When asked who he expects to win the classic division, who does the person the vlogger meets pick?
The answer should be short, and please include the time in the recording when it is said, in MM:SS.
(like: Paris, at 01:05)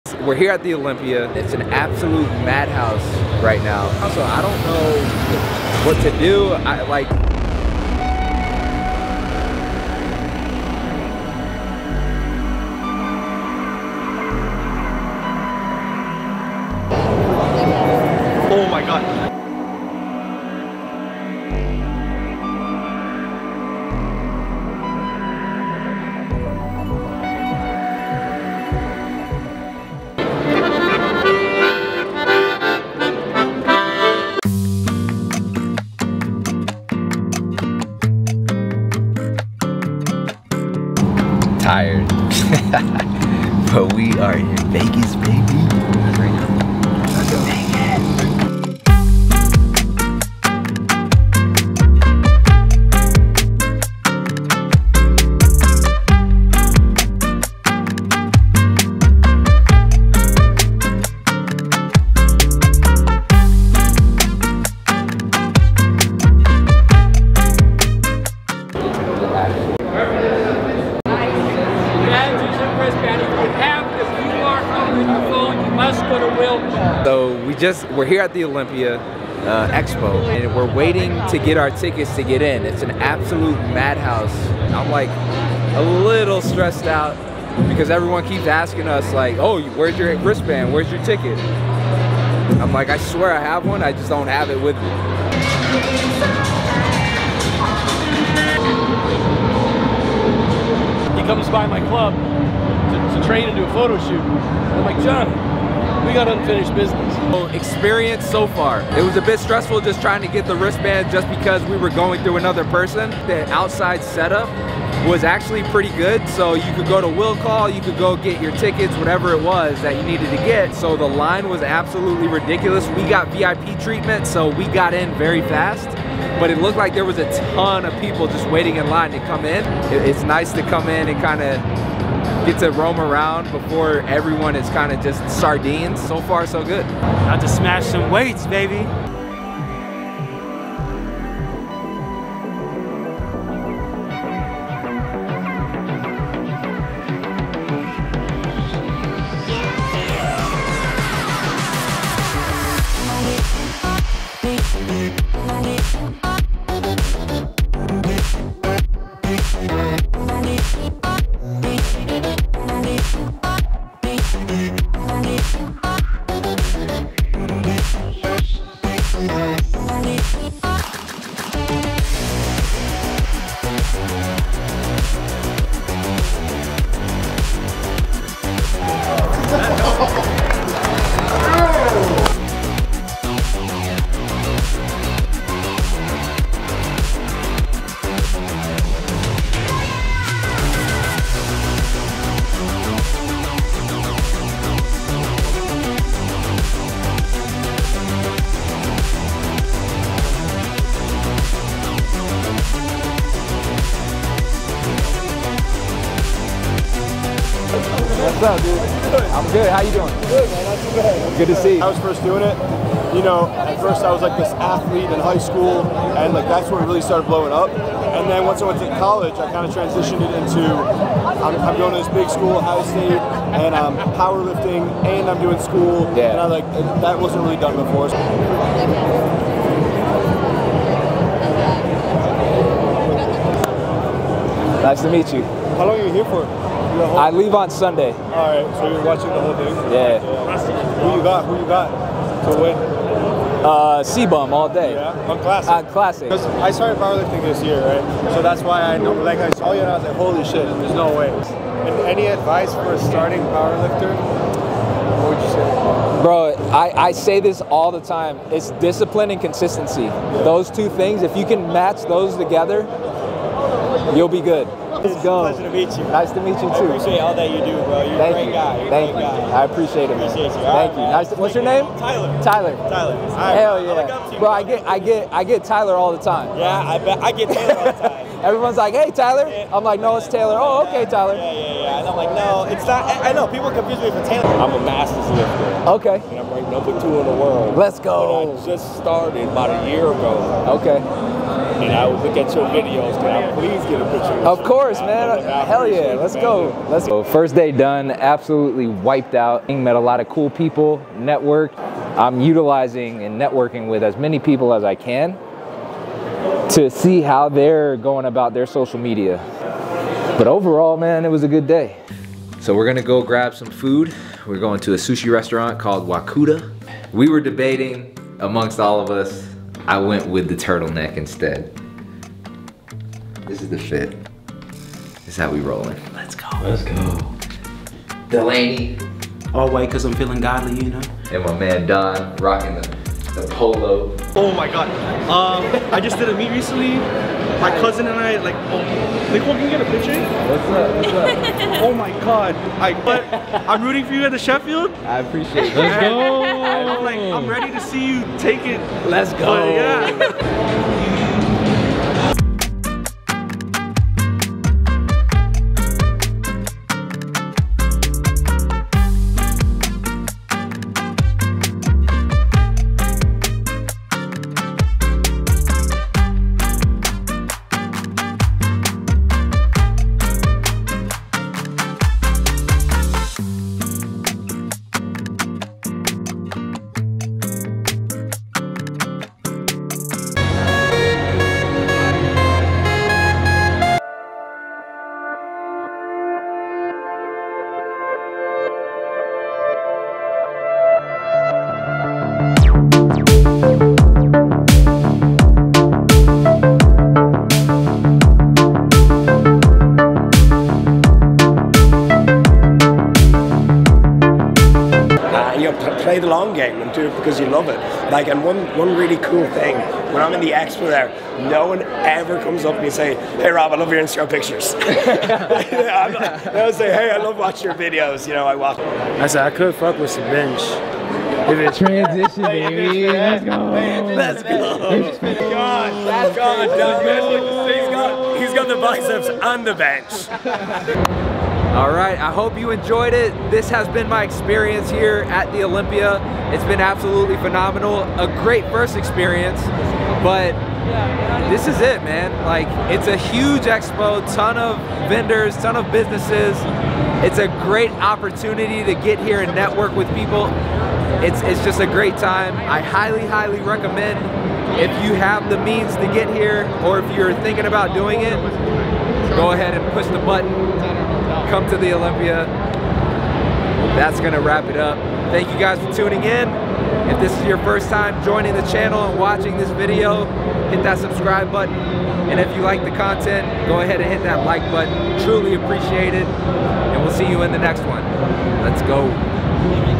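C-bum, at 04:04.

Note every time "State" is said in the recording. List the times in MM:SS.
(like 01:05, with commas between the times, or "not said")
03:42.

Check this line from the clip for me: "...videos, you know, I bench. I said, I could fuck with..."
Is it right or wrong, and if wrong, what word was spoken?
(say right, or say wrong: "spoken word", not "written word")
wrong: "watch", not "bench".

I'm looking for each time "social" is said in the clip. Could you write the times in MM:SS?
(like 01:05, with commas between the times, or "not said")
05:08.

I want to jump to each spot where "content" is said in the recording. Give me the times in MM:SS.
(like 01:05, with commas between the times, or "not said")
07:52.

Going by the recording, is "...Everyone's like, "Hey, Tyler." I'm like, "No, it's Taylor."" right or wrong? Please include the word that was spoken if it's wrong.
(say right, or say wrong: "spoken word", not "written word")
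right.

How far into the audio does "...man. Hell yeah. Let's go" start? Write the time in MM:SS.
04:54.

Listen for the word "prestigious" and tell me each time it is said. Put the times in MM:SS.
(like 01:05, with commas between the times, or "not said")
not said.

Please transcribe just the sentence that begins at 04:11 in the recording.
And any advice for a starting powerlifter?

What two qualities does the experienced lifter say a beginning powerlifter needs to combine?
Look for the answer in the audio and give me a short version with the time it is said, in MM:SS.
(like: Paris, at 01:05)
Discipline and consistency, at 04:18.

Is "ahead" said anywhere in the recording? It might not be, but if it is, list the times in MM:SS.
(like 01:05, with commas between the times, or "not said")
07:39, 07:53.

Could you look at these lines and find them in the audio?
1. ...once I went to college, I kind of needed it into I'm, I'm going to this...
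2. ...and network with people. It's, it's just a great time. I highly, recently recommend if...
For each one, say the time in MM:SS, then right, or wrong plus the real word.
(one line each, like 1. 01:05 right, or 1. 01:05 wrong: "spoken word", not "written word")
1. 03:38 wrong: "transitioned", not "needed"
2. 07:29 wrong: "highly", not "recently".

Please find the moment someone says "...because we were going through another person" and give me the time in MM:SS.
01:51.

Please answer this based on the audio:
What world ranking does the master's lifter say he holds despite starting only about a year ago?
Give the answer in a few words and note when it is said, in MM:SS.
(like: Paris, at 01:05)
Number 2, at 04:46.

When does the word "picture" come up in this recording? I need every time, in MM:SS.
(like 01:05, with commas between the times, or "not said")
04:54, 05:39, 06:54.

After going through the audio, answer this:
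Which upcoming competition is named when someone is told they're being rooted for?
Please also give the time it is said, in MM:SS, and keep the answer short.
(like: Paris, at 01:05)
Sheffield, at 05:44.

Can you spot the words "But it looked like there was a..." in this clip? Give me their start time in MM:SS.
02:06.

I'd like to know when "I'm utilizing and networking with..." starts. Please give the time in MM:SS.
05:02.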